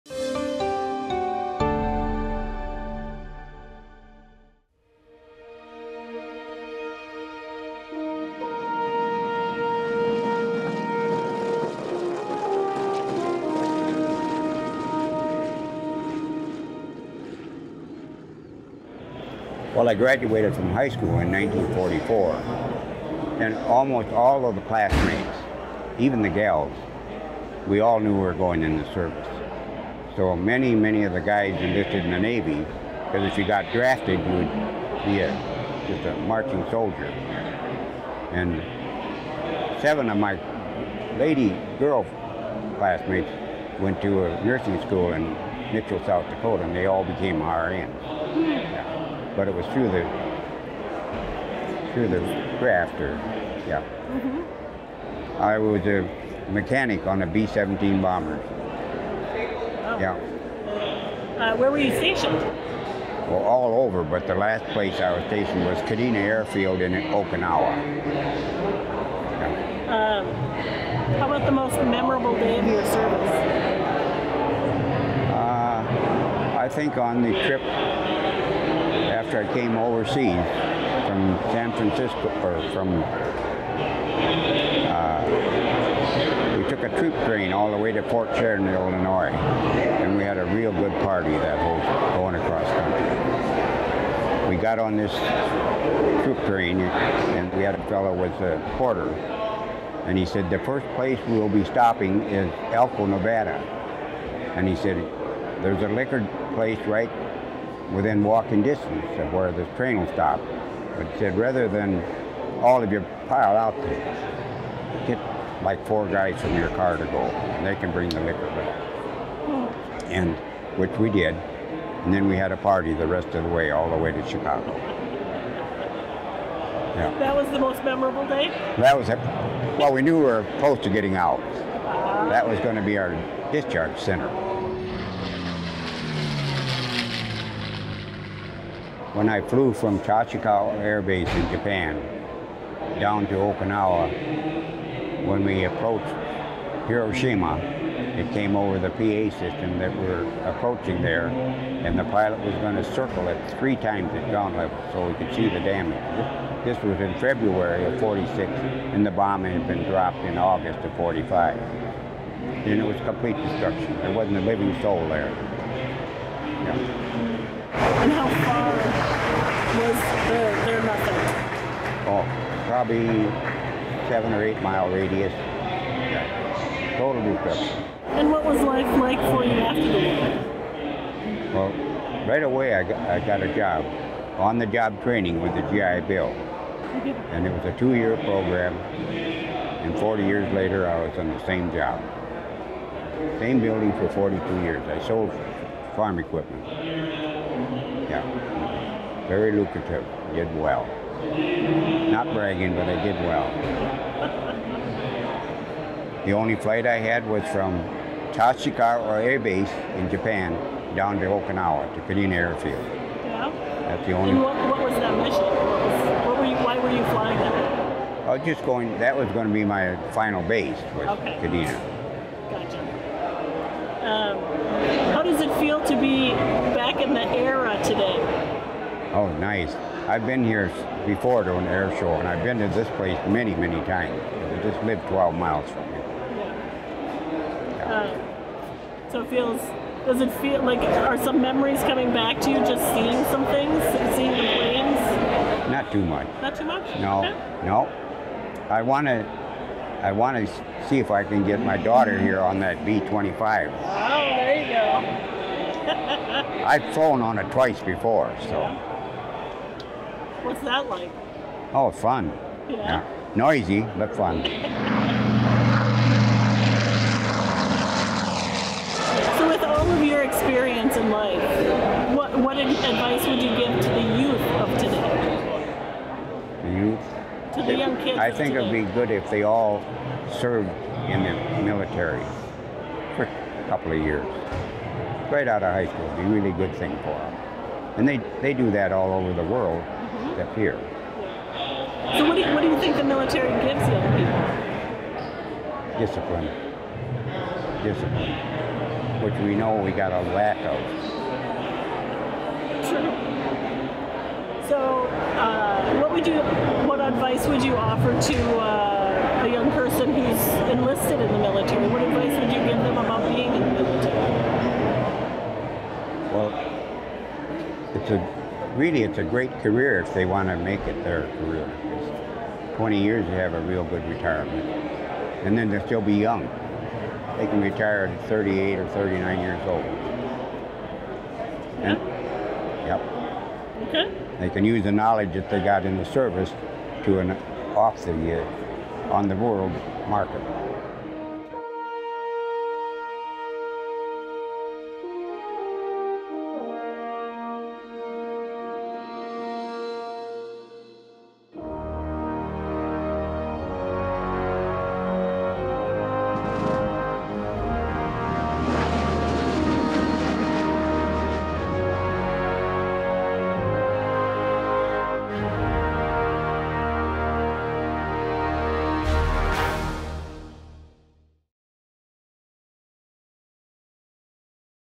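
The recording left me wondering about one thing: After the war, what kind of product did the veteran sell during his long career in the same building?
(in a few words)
Farm equipment.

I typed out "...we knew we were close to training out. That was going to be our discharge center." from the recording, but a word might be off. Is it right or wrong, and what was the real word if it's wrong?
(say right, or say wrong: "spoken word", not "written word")
wrong: "getting", not "training".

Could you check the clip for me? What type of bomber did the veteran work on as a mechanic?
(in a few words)
B-17.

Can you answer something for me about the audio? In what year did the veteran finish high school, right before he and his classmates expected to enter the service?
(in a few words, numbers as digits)
1944.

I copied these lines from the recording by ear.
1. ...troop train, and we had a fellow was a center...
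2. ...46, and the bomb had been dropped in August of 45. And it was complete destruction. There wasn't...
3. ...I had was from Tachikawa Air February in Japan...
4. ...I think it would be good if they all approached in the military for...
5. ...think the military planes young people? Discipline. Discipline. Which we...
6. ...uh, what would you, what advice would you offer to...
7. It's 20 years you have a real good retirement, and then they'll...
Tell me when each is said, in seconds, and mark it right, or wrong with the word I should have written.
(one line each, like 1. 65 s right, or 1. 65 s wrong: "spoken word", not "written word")
1. 96 s wrong: "porter", not "center"
2. 157 s right
3. 206 s wrong: "Base", not "February"
4. 278 s wrong: "served", not "approached"
5. 292 s wrong: "gives", not "planes"
6. 305 s right
7. 322 s right.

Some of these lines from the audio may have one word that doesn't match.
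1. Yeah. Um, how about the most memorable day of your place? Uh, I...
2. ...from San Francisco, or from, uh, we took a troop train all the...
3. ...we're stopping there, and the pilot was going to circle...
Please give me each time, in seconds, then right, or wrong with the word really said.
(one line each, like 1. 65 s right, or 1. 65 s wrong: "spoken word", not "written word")
1. 67 s wrong: "service", not "place"
2. 81 s right
3. 149 s wrong: "approaching", not "stopping".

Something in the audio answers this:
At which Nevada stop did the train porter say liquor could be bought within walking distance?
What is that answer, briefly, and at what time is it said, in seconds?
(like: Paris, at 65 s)
Elko, at 102 s.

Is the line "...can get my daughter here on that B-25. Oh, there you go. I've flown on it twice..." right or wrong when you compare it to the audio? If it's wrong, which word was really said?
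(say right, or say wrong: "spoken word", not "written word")
right.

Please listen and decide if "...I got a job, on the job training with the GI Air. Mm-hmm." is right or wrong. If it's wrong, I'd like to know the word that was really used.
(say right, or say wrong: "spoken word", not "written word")
wrong: "Bill", not "Air".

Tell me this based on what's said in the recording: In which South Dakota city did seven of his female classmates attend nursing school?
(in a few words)
Mitchell.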